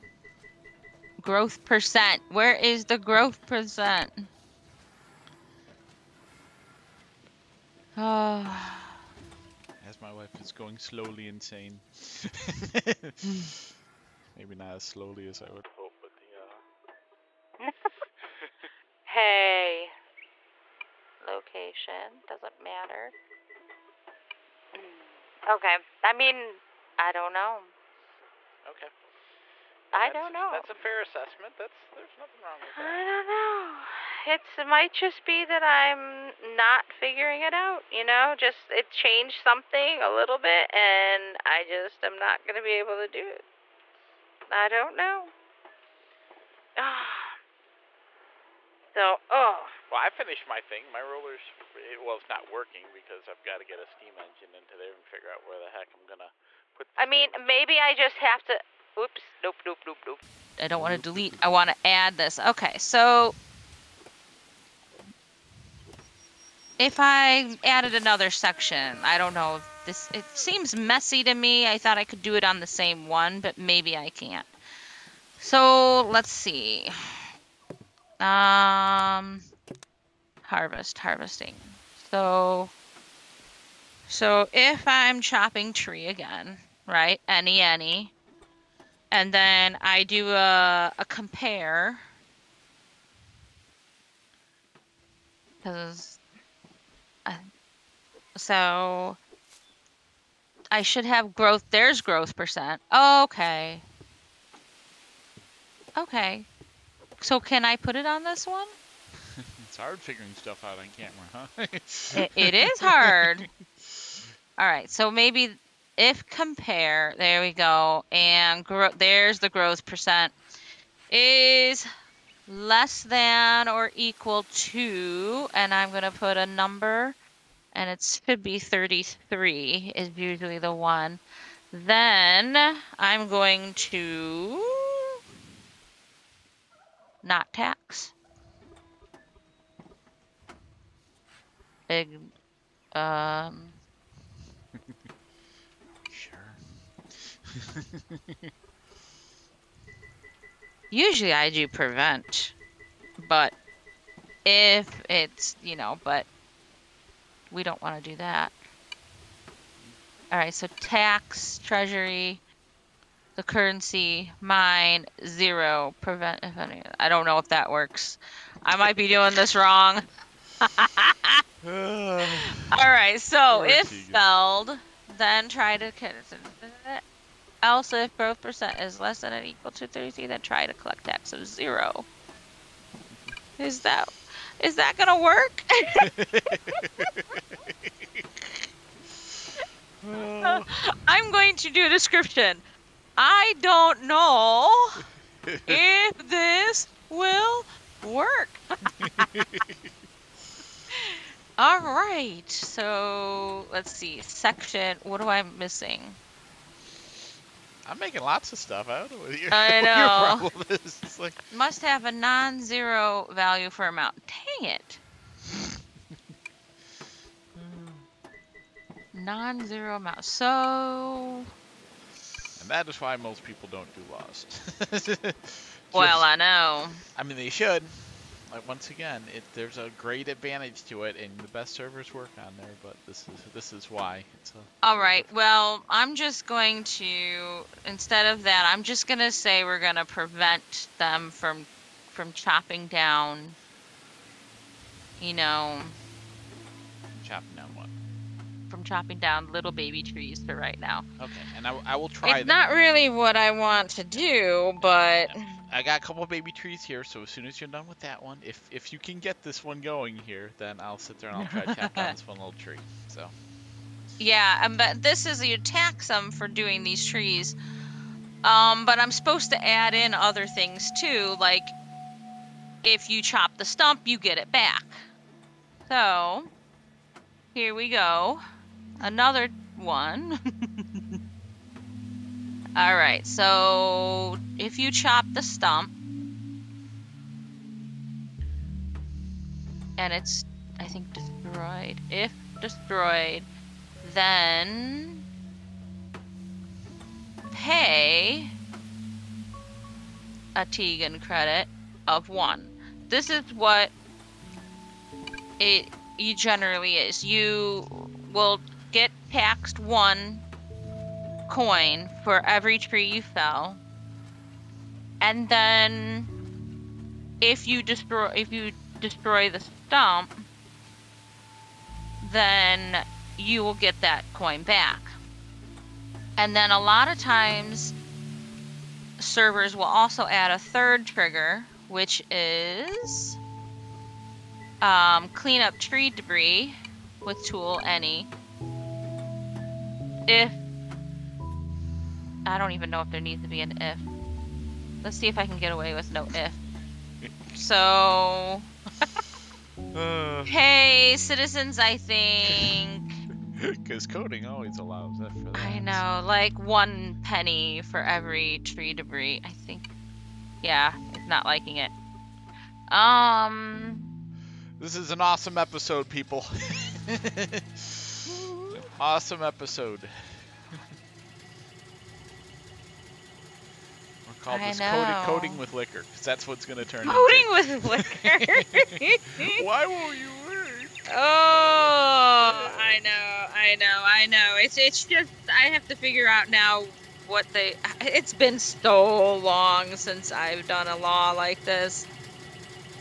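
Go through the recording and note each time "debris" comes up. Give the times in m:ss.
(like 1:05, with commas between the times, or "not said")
5:36, 5:58.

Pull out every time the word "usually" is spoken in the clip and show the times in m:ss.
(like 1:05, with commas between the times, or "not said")
2:10, 2:30.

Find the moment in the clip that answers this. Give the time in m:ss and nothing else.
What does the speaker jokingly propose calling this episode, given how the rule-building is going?
6:15.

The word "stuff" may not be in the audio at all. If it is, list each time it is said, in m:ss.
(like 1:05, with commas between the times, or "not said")
1:50, 3:28.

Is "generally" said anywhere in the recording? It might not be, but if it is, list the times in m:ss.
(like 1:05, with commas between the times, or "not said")
5:06.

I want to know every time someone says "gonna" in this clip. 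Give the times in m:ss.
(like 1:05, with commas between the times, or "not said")
0:42, 0:56, 3:04.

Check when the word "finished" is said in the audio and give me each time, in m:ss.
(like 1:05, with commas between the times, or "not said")
0:50.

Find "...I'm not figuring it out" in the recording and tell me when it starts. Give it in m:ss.
0:35.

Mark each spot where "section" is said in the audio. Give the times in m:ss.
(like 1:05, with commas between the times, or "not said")
1:08, 3:24.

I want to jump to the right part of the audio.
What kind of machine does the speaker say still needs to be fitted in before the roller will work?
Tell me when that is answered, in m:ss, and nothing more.
0:53.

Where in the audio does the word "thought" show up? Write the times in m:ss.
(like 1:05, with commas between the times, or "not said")
1:11.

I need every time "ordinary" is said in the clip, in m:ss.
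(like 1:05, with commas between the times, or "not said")
not said.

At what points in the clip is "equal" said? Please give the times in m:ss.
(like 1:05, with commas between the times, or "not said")
2:03, 2:59.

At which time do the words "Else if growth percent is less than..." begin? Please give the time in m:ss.
2:57.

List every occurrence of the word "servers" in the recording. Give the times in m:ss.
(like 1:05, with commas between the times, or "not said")
3:51, 5:29.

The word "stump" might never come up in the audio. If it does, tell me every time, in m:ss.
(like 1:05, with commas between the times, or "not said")
4:33, 4:45, 5:19.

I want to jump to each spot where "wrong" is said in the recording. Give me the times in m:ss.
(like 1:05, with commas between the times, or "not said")
0:32, 2:49.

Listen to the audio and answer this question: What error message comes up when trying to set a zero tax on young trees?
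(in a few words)
Must have a non-zero value for amount.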